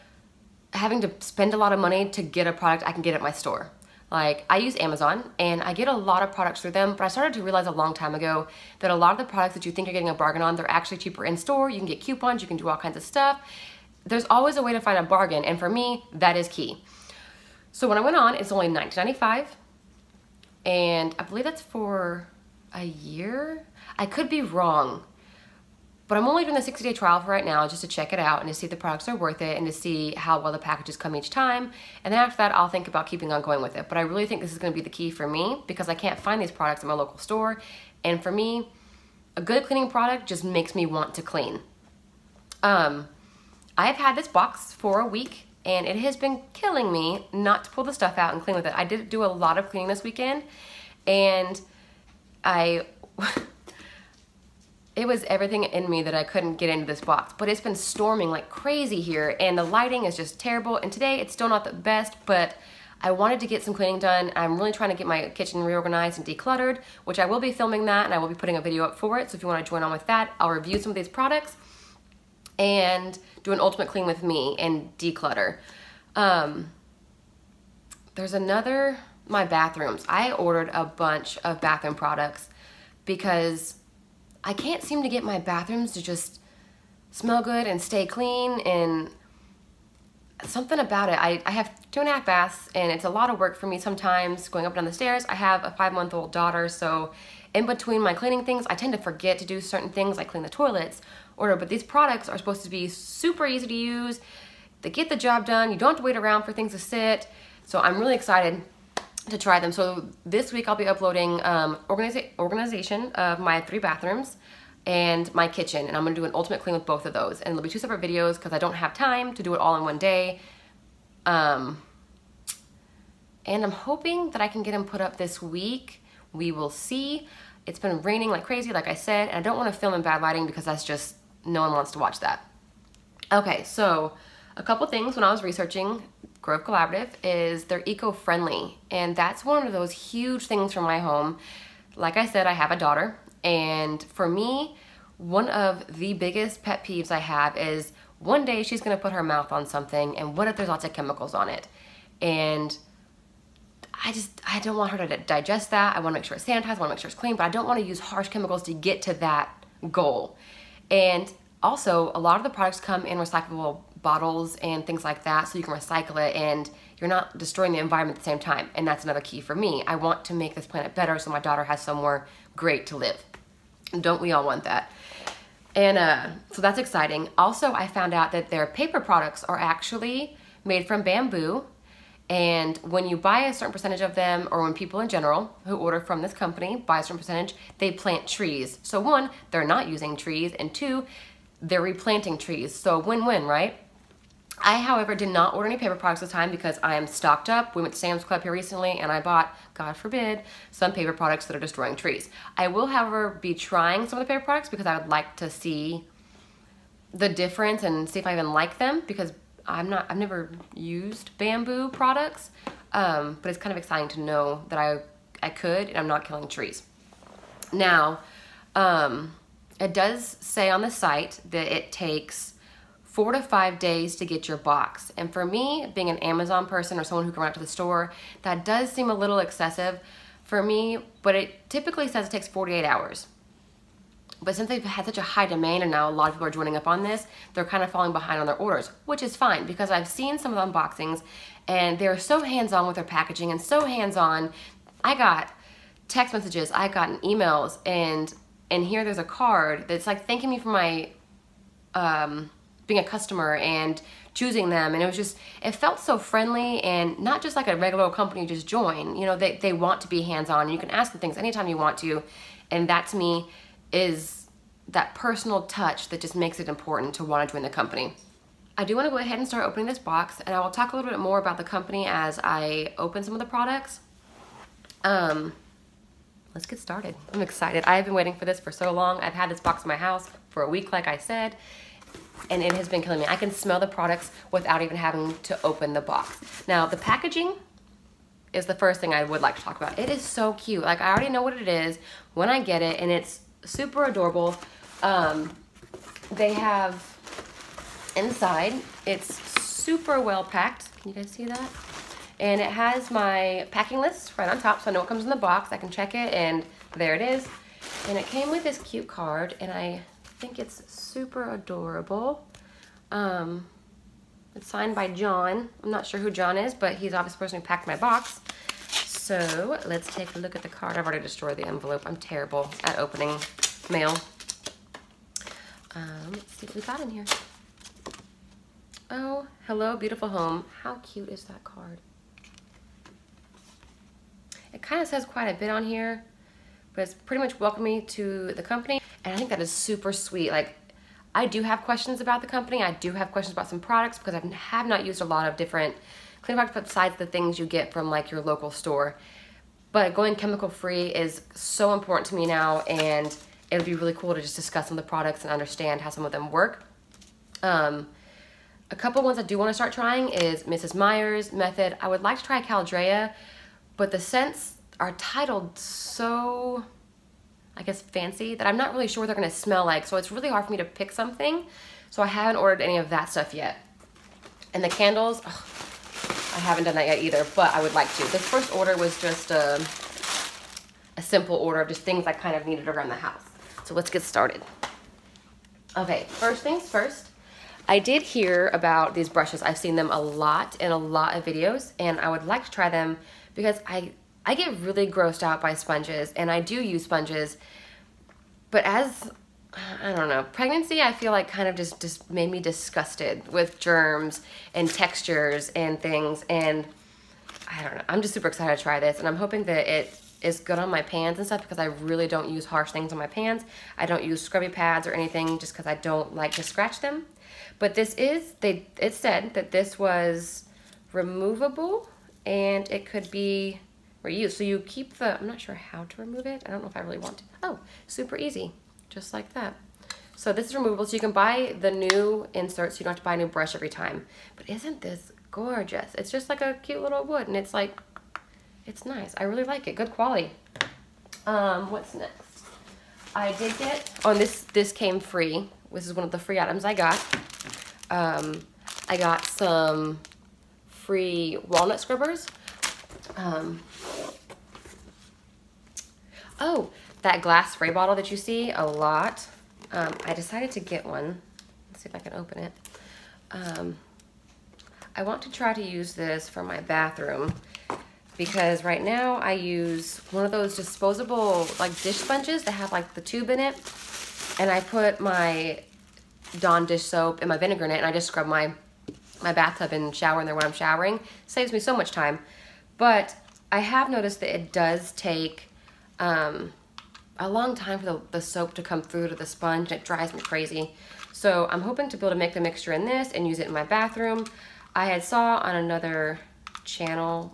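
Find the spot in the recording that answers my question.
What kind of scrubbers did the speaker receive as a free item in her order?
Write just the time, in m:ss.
7:31.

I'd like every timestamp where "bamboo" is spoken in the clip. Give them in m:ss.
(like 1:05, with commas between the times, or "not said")
3:01, 3:31.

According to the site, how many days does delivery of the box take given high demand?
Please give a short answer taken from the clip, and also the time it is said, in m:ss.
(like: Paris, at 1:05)
4 to 5 days, at 3:43.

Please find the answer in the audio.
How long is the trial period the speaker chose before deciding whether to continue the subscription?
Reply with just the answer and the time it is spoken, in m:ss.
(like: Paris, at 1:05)
60 days, at 0:26.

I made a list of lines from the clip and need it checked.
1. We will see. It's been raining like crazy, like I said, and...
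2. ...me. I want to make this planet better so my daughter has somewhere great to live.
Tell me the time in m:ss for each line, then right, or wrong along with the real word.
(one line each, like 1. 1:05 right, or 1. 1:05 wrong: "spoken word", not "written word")
1. 2:06 right
2. 2:49 right.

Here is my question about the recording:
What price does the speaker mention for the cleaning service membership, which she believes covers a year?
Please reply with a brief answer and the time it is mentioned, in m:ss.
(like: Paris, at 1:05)
$19.95, at 0:18.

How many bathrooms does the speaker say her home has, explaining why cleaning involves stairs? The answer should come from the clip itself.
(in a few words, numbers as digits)
2.5.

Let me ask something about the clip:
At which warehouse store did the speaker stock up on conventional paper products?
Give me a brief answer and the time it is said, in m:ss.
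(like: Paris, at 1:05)
Sam's Club, at 3:17.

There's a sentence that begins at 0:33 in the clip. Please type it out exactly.
But I really think this is gonna be the key for me because I can't find these products at my local store.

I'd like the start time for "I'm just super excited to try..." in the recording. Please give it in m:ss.
6:48.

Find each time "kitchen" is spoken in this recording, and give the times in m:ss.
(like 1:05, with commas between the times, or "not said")
1:05, 1:55.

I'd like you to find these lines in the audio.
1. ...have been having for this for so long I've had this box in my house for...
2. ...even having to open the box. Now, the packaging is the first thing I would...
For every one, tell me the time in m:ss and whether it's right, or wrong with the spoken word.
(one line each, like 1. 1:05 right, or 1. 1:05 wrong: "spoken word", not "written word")
1. 4:37 wrong: "waiting", not "having"
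2. 4:44 right.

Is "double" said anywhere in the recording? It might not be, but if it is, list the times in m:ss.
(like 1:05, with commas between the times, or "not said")
not said.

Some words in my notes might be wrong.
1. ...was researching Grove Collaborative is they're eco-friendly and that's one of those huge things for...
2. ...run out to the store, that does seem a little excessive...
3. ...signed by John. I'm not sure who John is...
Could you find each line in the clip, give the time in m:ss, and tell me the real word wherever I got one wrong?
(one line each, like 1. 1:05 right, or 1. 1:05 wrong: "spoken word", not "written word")
1. 2:15 right
2. 3:47 right
3. 5:14 right.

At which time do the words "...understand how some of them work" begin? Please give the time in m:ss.
5:55.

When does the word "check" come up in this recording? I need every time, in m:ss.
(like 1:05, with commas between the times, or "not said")
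0:27, 5:05.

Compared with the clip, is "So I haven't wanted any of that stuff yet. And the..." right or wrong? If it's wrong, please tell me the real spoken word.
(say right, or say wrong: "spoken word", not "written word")
wrong: "ordered", not "wanted".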